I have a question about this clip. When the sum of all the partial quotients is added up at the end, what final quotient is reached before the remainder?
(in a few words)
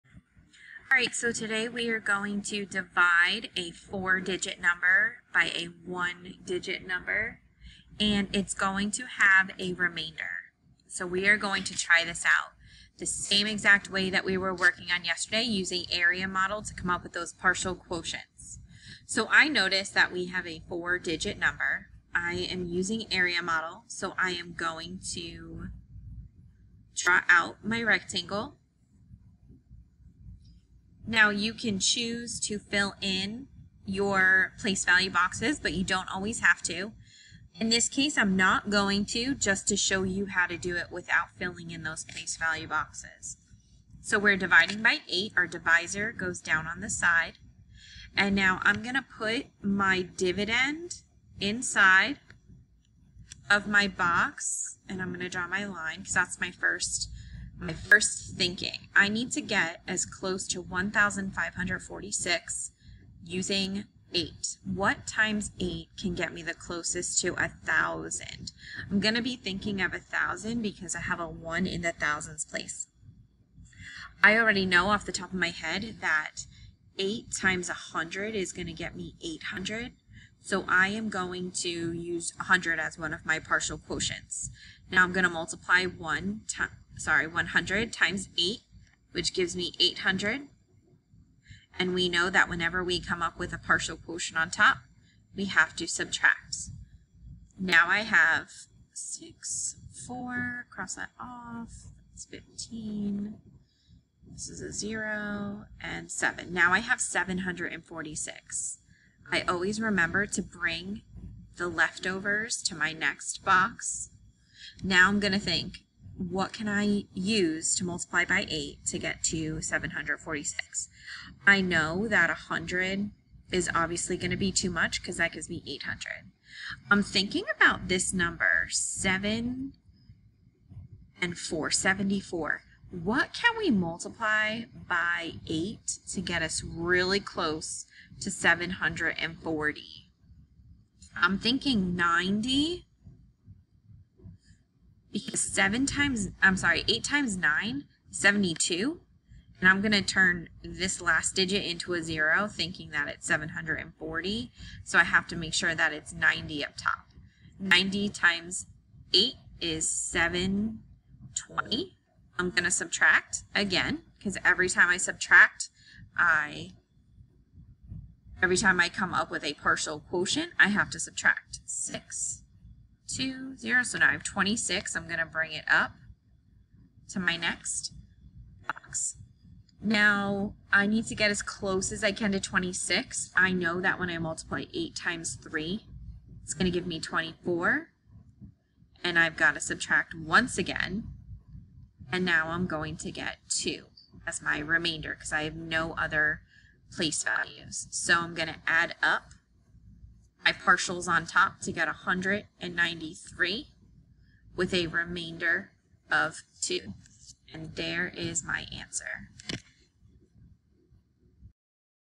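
193.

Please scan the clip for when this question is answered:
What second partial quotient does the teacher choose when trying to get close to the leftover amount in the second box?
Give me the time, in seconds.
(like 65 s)
141 s.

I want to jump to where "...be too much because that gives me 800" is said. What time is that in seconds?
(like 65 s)
124 s.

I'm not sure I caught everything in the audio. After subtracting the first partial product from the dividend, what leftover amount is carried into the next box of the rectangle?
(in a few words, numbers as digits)
746.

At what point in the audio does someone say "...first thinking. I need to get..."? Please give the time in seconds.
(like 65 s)
57 s.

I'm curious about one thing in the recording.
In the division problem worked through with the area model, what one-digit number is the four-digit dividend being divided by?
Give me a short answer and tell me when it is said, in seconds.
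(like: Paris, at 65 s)
8, at 44 s.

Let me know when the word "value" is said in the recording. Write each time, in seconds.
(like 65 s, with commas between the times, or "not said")
34 s, 42 s, 197 s.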